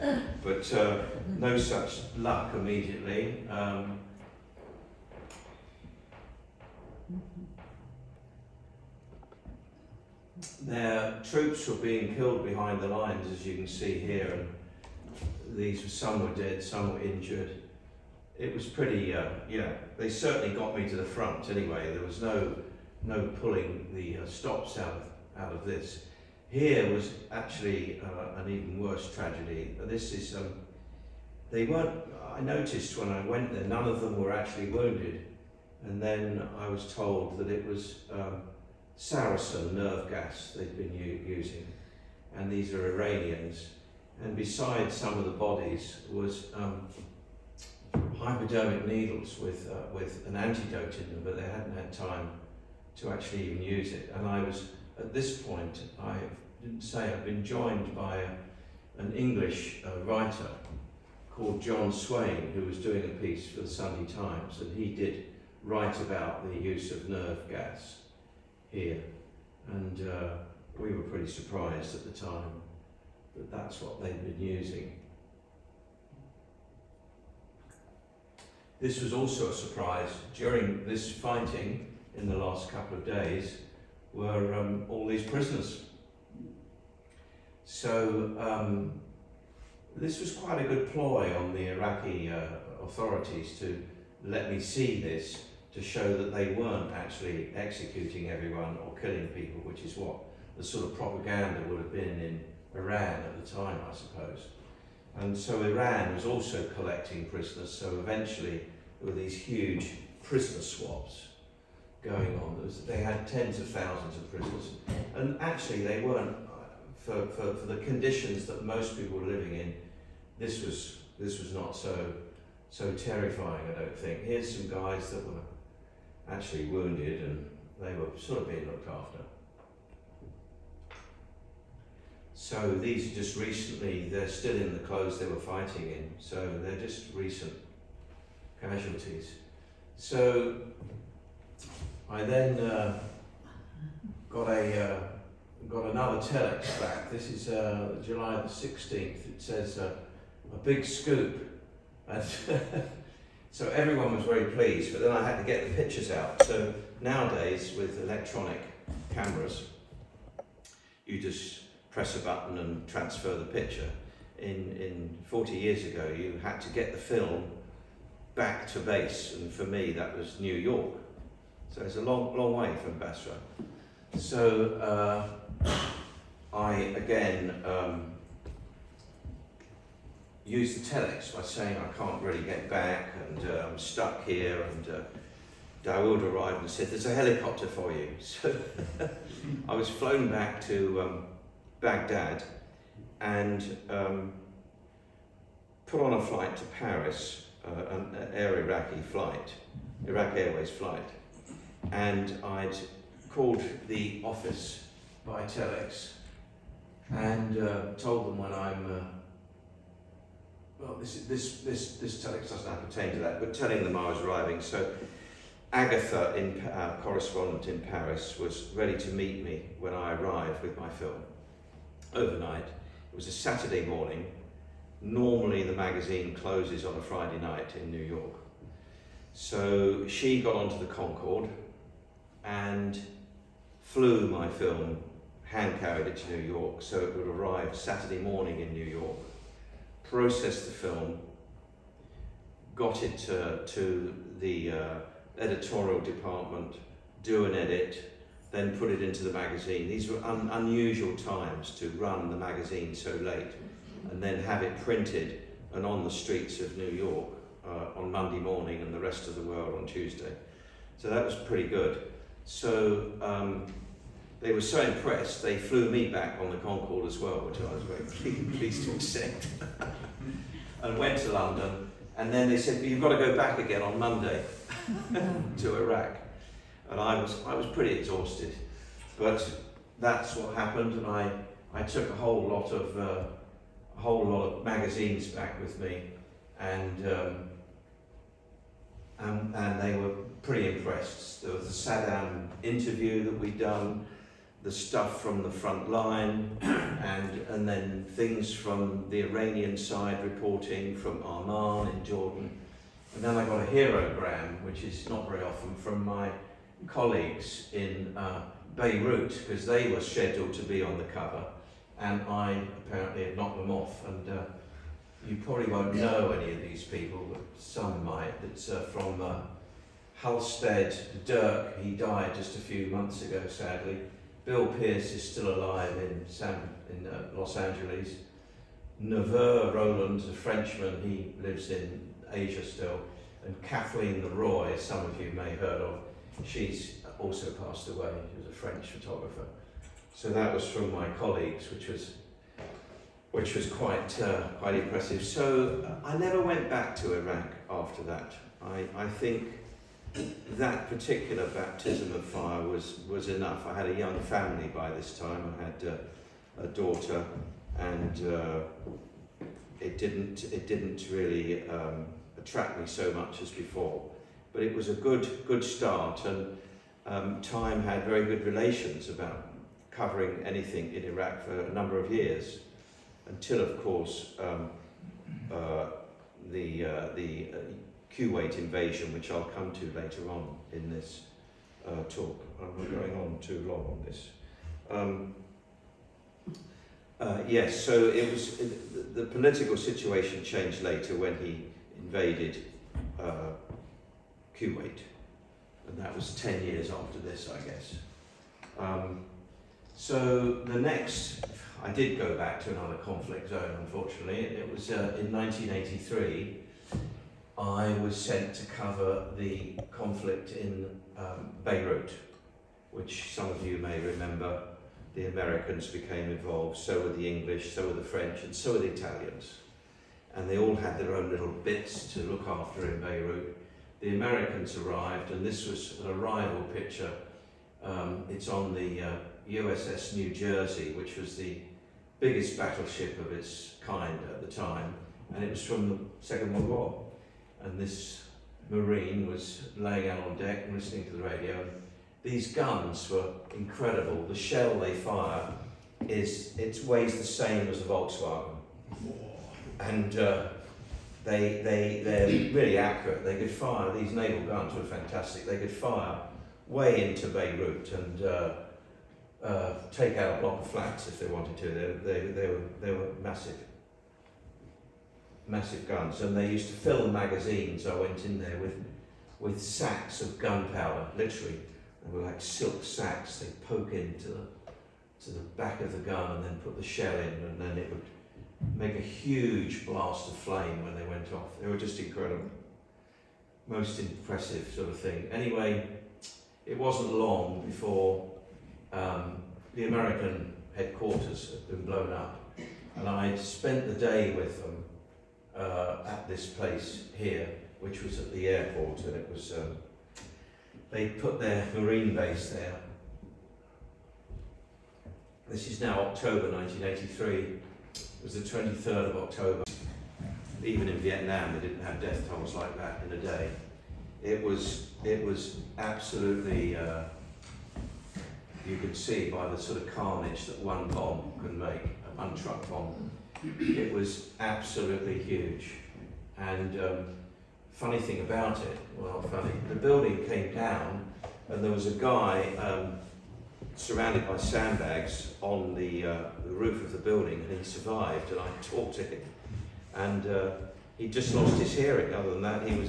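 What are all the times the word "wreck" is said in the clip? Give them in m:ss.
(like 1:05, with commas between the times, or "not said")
not said.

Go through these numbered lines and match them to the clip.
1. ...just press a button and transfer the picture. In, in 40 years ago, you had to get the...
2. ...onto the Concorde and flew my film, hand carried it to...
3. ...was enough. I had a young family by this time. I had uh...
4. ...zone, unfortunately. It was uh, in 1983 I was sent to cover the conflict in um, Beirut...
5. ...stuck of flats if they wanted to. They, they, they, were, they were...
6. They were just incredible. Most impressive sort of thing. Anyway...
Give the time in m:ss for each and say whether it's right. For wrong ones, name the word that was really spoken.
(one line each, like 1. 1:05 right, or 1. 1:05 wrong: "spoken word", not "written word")
1. 2:41 right
2. 3:50 right
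3. 5:53 right
4. 6:43 right
5. 7:40 wrong: "block", not "stuck"
6. 8:01 right.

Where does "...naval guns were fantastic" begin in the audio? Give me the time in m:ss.
7:34.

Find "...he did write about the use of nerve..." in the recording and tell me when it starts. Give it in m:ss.
1:04.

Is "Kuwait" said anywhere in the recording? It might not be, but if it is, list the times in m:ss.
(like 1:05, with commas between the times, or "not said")
6:18, 6:34.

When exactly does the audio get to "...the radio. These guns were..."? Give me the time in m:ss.
7:21.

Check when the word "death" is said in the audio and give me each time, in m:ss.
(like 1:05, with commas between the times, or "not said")
8:31.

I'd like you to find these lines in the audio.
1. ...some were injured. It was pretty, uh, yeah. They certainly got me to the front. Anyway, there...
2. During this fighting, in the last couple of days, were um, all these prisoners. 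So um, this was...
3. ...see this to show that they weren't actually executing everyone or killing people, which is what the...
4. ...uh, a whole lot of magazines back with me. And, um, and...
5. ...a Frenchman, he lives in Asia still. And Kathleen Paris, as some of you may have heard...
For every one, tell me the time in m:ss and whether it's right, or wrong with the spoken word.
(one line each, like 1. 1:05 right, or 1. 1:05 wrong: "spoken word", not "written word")
1. 0:16 right
2. 1:20 right
3. 1:34 right
4. 4:42 right
5. 5:30 wrong: "Leroy", not "Paris".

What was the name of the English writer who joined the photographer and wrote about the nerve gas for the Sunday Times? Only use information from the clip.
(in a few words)
John Swain.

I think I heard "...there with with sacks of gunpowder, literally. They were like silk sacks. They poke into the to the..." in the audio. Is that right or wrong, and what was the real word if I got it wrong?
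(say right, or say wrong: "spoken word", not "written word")
right.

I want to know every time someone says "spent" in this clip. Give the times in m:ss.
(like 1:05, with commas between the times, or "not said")
8:13.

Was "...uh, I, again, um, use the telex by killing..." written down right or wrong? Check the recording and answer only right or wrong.
wrong.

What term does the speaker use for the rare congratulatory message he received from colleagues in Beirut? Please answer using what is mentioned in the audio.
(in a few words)
herogram.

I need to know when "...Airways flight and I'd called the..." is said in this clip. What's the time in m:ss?
3:20.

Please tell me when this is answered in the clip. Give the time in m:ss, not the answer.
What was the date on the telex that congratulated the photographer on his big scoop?
2:28.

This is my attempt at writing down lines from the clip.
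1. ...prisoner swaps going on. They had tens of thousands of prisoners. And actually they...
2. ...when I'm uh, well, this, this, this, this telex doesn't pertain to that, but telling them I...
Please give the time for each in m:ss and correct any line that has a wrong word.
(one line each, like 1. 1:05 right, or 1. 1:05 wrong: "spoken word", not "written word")
1. 1:50 right
2. 3:28 right.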